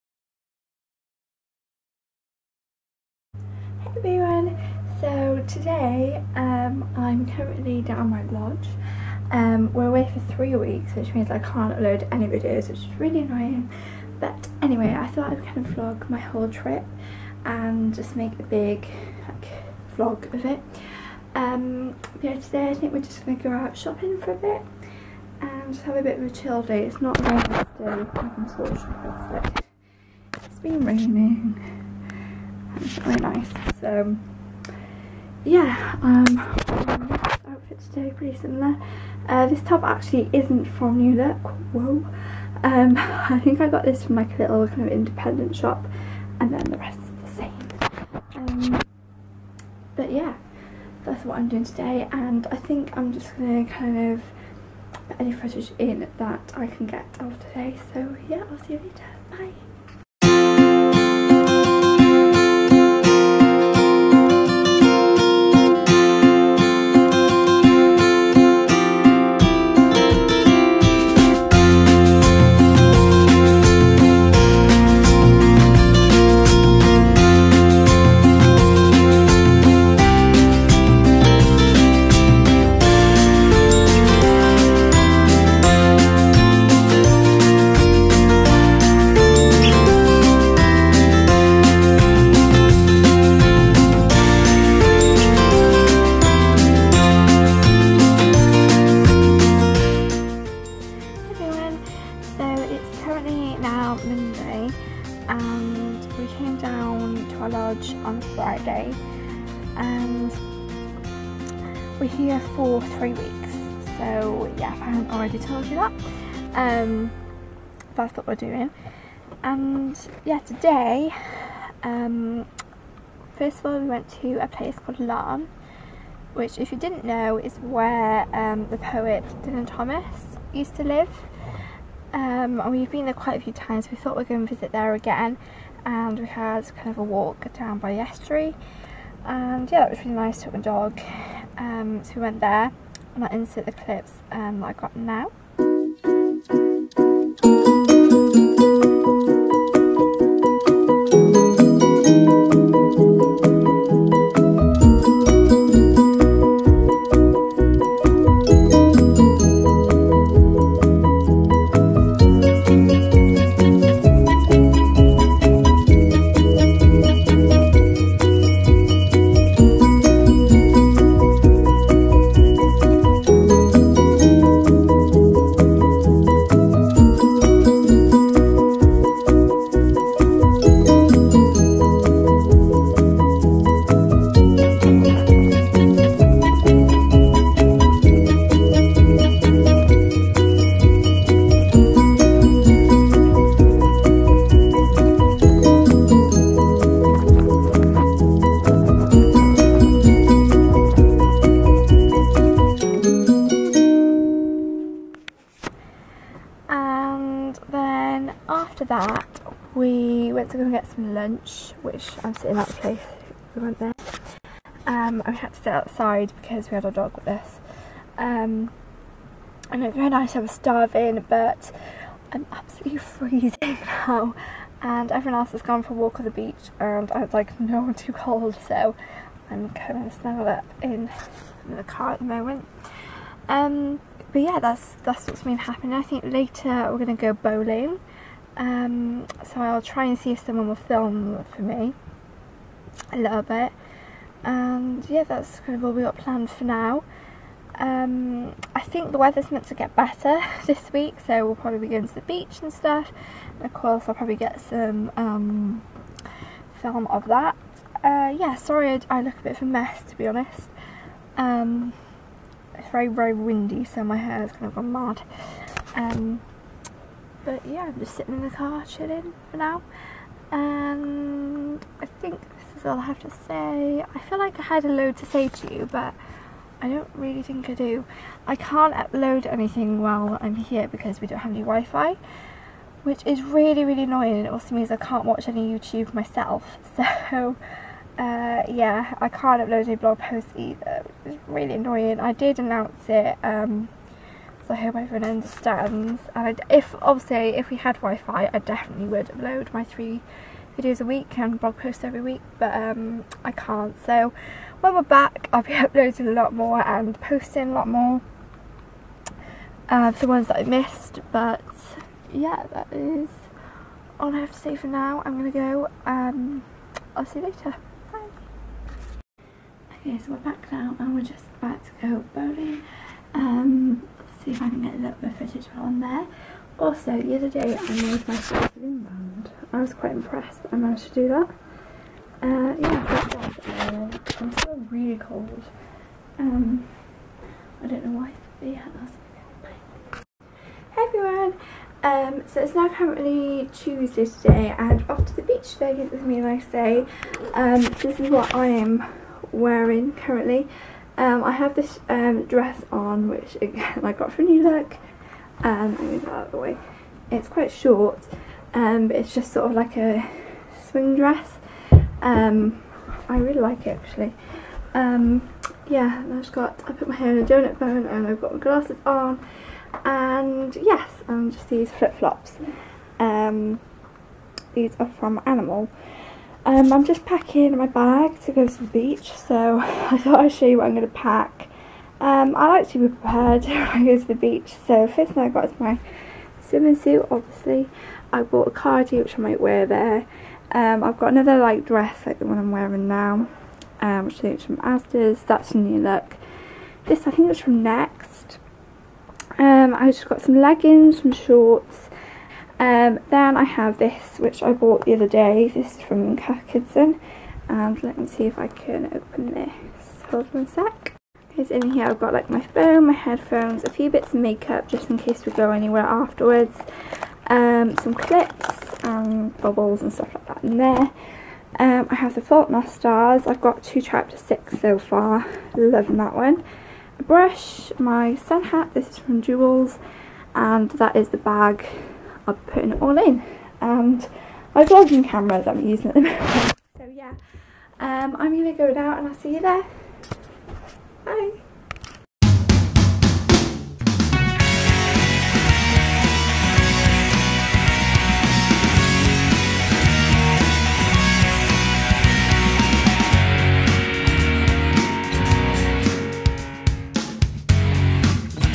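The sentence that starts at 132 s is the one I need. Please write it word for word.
Um, and we've been there quite a few times.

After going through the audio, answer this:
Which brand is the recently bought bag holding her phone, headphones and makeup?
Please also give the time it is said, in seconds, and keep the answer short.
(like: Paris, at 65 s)
Cath Kidston, at 406 s.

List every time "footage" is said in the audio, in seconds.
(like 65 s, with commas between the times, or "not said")
55 s, 325 s.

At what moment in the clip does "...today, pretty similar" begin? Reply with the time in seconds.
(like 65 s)
37 s.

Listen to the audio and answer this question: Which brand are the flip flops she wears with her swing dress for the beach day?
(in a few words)
Animal.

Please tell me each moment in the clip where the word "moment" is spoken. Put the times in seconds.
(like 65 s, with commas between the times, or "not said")
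232 s, 436 s.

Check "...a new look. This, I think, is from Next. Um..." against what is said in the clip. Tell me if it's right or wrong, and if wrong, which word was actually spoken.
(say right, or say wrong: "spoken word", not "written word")
right.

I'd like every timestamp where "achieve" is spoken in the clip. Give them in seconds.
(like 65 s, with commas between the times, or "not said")
not said.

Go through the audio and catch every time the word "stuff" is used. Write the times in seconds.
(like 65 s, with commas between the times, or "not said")
252 s, 420 s.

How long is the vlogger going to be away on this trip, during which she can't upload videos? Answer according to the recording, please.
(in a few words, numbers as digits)
3 weeks.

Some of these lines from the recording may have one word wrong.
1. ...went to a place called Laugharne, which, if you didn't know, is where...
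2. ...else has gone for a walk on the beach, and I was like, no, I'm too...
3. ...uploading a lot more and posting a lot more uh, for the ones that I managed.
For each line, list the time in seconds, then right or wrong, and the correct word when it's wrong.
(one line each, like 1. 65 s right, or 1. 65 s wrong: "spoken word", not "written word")
1. 123 s right
2. 225 s right
3. 305 s wrong: "missed", not "managed".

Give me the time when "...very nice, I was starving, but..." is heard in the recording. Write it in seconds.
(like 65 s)
219 s.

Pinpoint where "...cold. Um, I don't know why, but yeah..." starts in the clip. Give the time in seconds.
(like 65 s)
335 s.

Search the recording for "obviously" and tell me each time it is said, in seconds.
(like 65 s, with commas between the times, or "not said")
297 s, 387 s.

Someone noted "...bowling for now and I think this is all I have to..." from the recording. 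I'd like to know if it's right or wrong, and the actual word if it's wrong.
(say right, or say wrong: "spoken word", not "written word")
wrong: "chilling", not "bowling".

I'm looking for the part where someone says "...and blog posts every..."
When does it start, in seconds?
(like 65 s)
301 s.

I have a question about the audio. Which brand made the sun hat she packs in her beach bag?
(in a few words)
Joules.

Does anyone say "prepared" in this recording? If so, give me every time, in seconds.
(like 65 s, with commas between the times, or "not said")
383 s.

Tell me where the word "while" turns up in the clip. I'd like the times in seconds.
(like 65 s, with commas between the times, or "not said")
280 s, 325 s.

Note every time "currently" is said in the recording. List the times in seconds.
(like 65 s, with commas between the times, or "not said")
7 s, 342 s, 350 s.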